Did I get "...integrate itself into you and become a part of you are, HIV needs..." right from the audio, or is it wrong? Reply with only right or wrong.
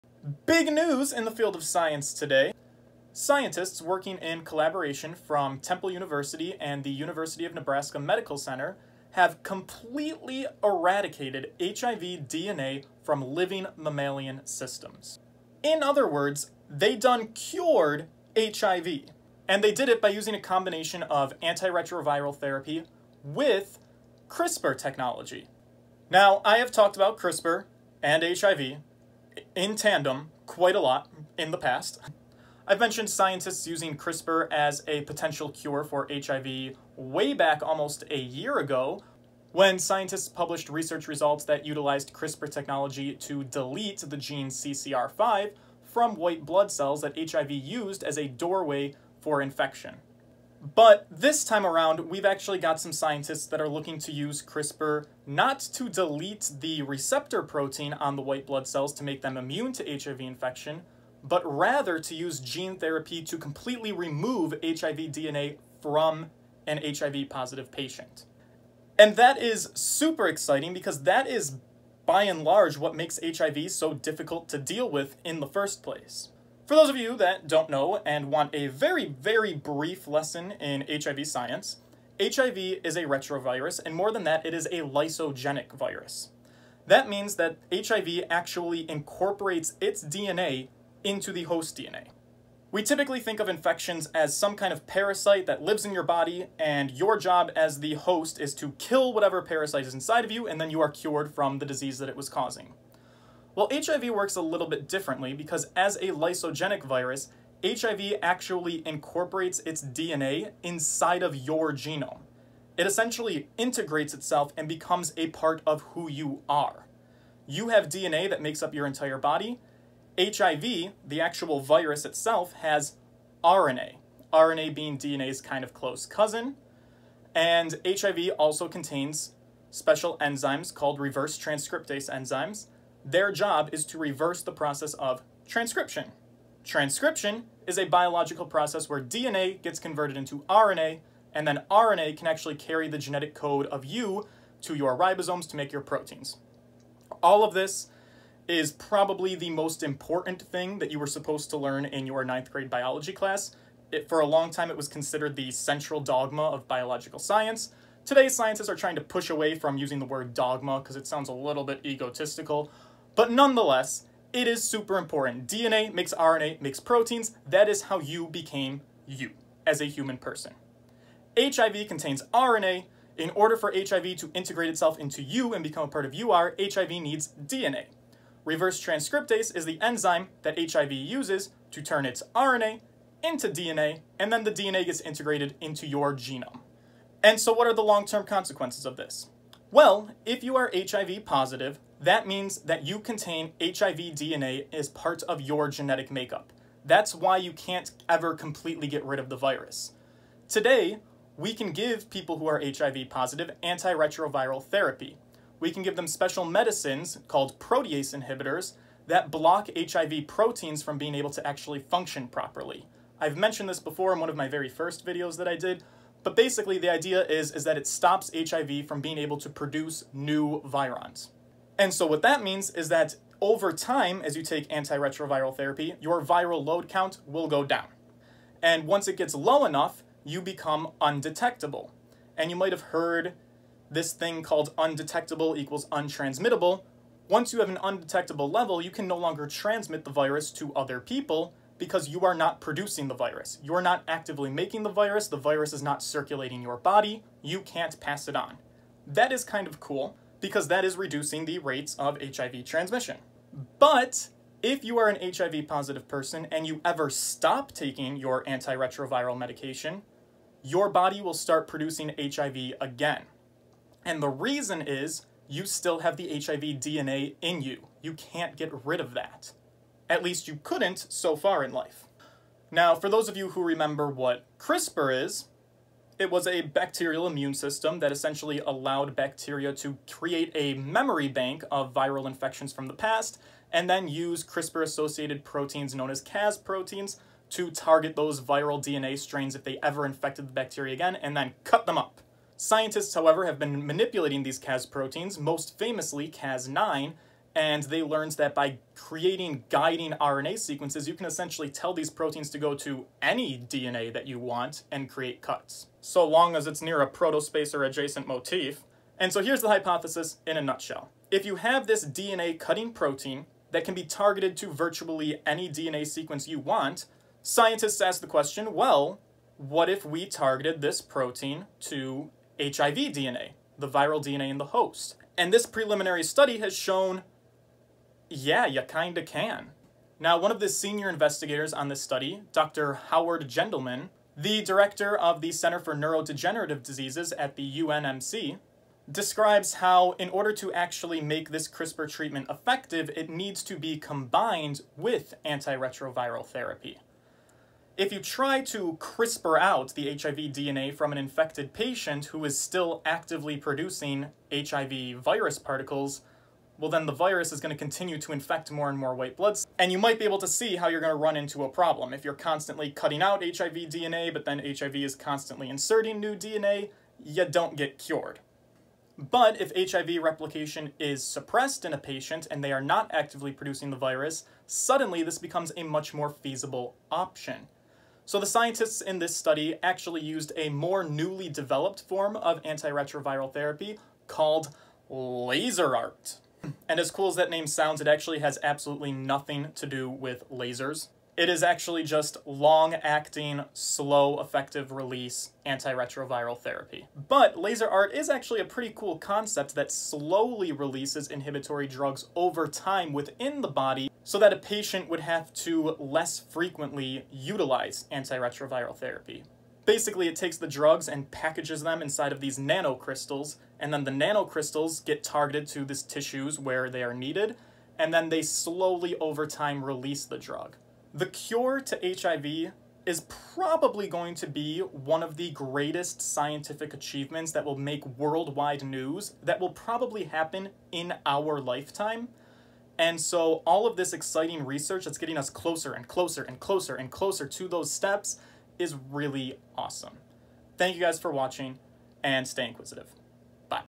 right.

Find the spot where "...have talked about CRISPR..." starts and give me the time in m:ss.
0:26.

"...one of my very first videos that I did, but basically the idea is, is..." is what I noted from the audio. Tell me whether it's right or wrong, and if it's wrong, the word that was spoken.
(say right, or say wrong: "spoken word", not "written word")
right.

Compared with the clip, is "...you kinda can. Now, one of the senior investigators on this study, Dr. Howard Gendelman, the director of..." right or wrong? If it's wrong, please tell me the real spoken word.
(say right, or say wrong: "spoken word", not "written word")
right.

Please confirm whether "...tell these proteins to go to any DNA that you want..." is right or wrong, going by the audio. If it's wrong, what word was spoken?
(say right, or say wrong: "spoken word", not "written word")
right.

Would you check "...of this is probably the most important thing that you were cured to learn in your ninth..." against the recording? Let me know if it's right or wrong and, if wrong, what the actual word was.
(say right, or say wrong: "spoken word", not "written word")
wrong: "supposed", not "cured".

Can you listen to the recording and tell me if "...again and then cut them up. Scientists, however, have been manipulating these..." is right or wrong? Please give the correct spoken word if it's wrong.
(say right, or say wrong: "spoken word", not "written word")
right.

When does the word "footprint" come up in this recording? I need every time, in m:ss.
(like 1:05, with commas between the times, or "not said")
not said.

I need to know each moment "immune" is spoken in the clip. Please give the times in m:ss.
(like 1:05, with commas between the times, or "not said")
0:59, 4:37.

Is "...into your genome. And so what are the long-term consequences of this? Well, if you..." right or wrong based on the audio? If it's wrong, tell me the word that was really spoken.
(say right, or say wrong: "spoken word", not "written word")
right.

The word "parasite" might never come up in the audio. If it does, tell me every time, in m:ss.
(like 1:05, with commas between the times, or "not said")
1:34, 1:39.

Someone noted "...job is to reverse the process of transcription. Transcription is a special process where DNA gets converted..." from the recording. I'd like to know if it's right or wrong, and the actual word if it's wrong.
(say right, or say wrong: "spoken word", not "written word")
wrong: "biological", not "special".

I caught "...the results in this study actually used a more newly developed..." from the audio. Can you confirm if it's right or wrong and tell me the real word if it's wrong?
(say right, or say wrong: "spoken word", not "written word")
wrong: "scientists", not "results".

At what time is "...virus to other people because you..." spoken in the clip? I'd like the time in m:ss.
4:00.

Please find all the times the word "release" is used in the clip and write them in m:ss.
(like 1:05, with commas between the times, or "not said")
6:34, 6:40, 6:59.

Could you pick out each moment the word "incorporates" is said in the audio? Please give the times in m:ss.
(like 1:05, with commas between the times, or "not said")
1:28, 1:48.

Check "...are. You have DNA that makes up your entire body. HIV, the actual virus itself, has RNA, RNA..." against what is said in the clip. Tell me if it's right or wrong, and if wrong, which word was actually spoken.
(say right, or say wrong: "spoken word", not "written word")
right.